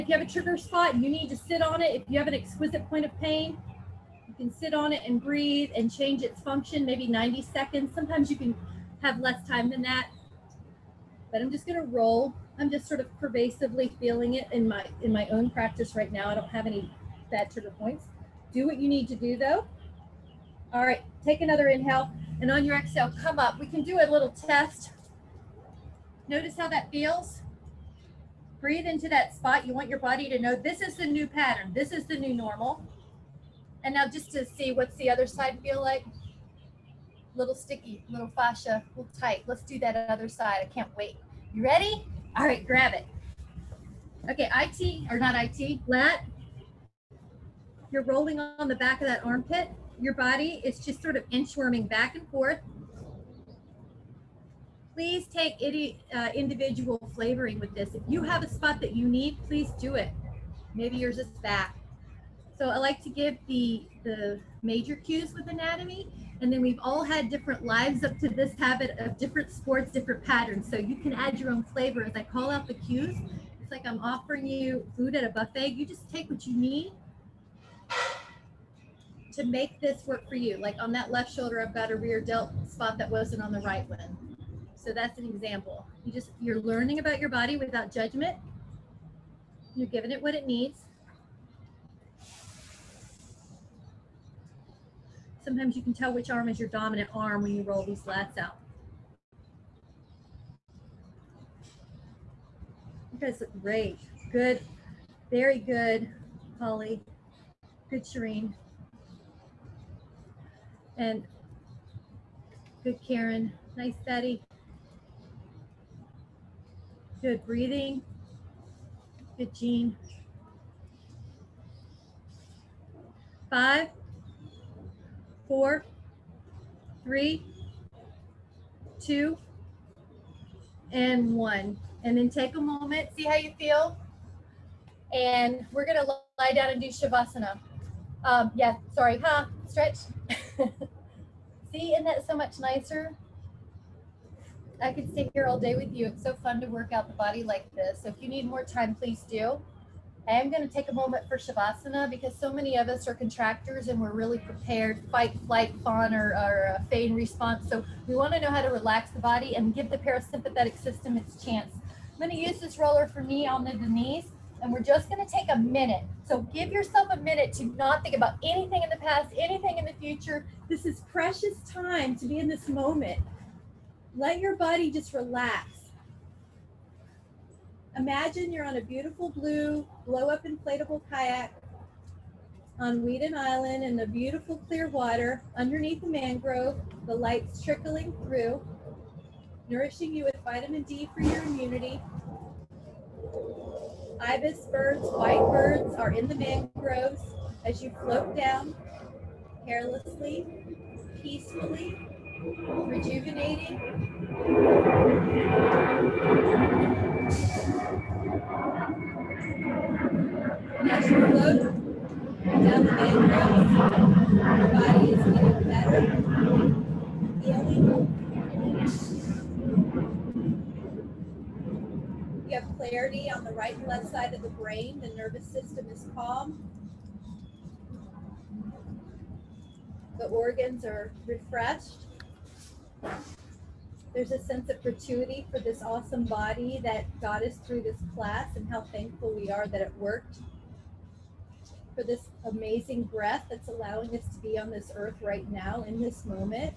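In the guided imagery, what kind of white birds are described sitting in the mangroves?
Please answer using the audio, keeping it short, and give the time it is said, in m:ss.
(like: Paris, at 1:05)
Ibis, at 3:14.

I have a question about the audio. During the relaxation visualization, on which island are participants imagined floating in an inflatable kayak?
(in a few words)
Weedon Island.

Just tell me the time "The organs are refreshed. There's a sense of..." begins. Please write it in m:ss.
3:50.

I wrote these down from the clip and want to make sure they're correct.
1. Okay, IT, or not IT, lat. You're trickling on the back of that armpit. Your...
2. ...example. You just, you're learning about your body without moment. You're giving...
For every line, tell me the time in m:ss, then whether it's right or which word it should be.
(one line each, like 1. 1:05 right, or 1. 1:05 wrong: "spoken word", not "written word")
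1. 0:44 wrong: "rolling", not "trickling"
2. 1:25 wrong: "judgment", not "moment".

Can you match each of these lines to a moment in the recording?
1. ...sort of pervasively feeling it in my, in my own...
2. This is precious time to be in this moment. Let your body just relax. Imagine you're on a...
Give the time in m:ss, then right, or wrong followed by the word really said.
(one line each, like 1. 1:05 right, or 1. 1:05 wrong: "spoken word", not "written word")
1. 0:12 right
2. 2:50 right.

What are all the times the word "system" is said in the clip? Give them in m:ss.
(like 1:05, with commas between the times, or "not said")
2:40, 3:45.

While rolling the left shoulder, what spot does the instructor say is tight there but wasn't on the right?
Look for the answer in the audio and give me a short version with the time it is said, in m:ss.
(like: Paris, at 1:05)
rear delt, at 1:21.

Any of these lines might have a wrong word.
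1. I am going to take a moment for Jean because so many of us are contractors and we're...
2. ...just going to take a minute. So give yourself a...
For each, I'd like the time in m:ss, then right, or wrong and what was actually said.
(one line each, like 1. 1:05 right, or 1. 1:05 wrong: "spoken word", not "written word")
1. 2:30 wrong: "Shavasana", not "Jean"
2. 2:44 right.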